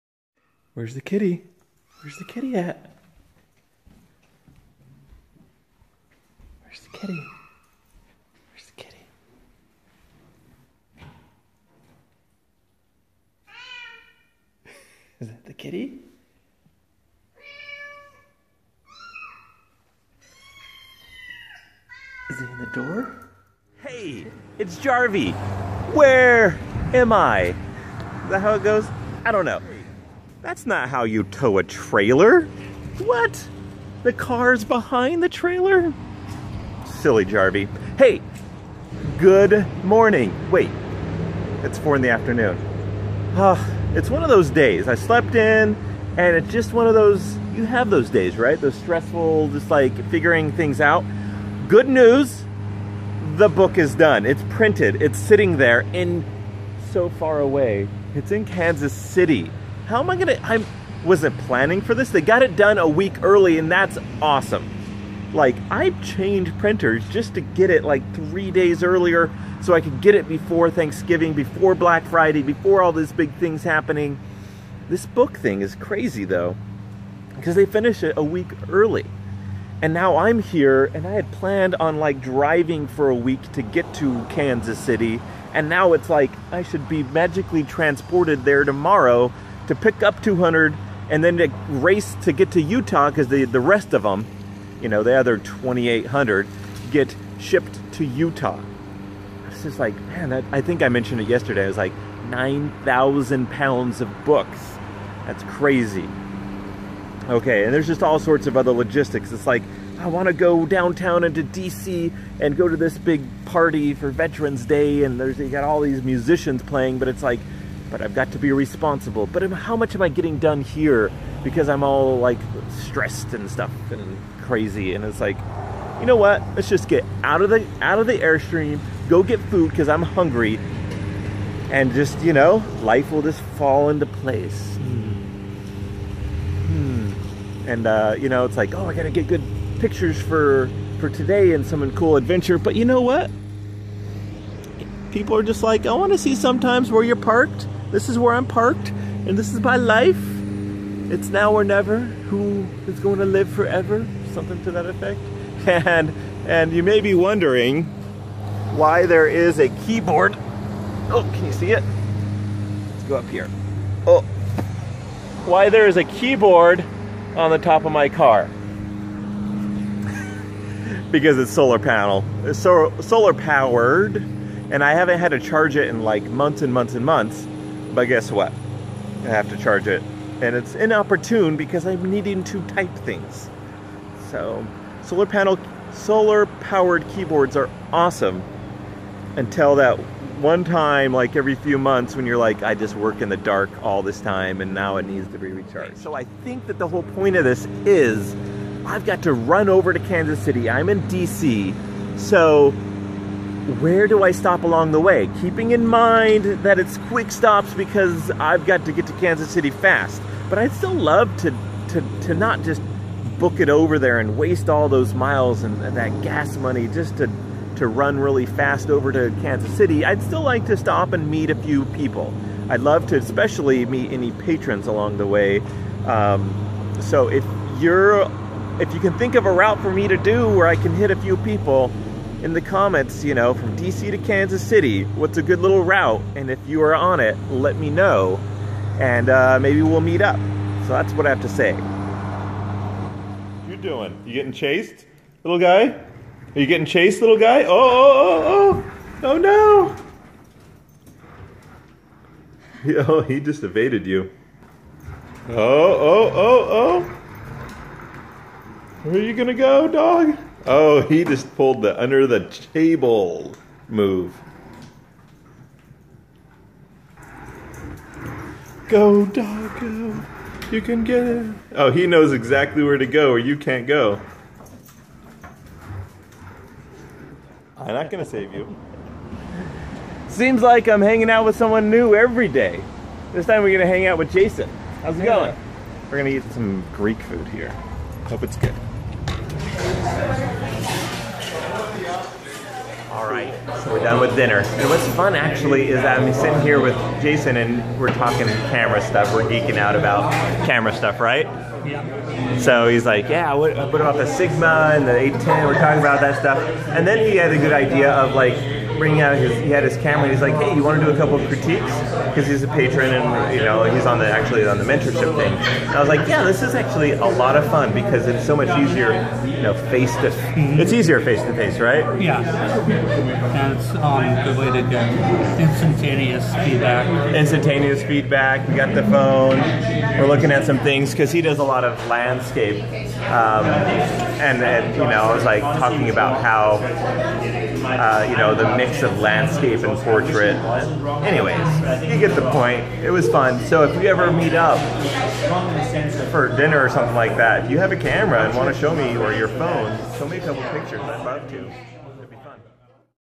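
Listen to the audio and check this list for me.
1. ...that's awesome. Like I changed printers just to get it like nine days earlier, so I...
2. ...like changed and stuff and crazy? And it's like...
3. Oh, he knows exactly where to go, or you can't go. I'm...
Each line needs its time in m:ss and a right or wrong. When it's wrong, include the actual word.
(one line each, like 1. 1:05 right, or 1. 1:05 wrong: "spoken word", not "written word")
1. 1:03 wrong: "three", not "nine"
2. 2:02 wrong: "stressed", not "changed"
3. 4:31 right.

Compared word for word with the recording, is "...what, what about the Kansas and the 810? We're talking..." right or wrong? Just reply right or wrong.
wrong.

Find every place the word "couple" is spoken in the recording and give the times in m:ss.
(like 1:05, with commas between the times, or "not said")
5:11, 5:50.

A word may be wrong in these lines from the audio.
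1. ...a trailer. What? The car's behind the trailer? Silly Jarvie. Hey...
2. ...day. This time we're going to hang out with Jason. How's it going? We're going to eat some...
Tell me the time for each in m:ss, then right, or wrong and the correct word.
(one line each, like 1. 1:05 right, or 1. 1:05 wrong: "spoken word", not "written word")
1. 0:31 right
2. 4:42 right.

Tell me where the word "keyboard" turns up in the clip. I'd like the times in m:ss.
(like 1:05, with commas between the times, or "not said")
2:39, 2:46, 3:07.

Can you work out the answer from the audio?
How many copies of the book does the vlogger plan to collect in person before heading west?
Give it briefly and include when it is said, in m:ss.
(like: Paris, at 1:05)
200, at 1:30.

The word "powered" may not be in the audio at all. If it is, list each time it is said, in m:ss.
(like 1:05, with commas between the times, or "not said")
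2:53, 3:06.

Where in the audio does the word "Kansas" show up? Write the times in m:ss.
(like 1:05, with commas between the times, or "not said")
0:58, 1:24, 3:19, 3:29, 3:39, 3:54.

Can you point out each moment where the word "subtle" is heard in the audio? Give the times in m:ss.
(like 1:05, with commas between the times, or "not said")
not said.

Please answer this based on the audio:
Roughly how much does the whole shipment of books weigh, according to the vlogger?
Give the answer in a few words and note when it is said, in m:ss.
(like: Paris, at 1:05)
9,000 pounds, at 1:42.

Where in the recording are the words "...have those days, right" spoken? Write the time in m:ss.
0:47.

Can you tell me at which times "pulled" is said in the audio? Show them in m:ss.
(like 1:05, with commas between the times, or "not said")
4:21.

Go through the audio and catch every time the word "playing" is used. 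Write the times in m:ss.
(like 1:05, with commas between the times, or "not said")
1:56.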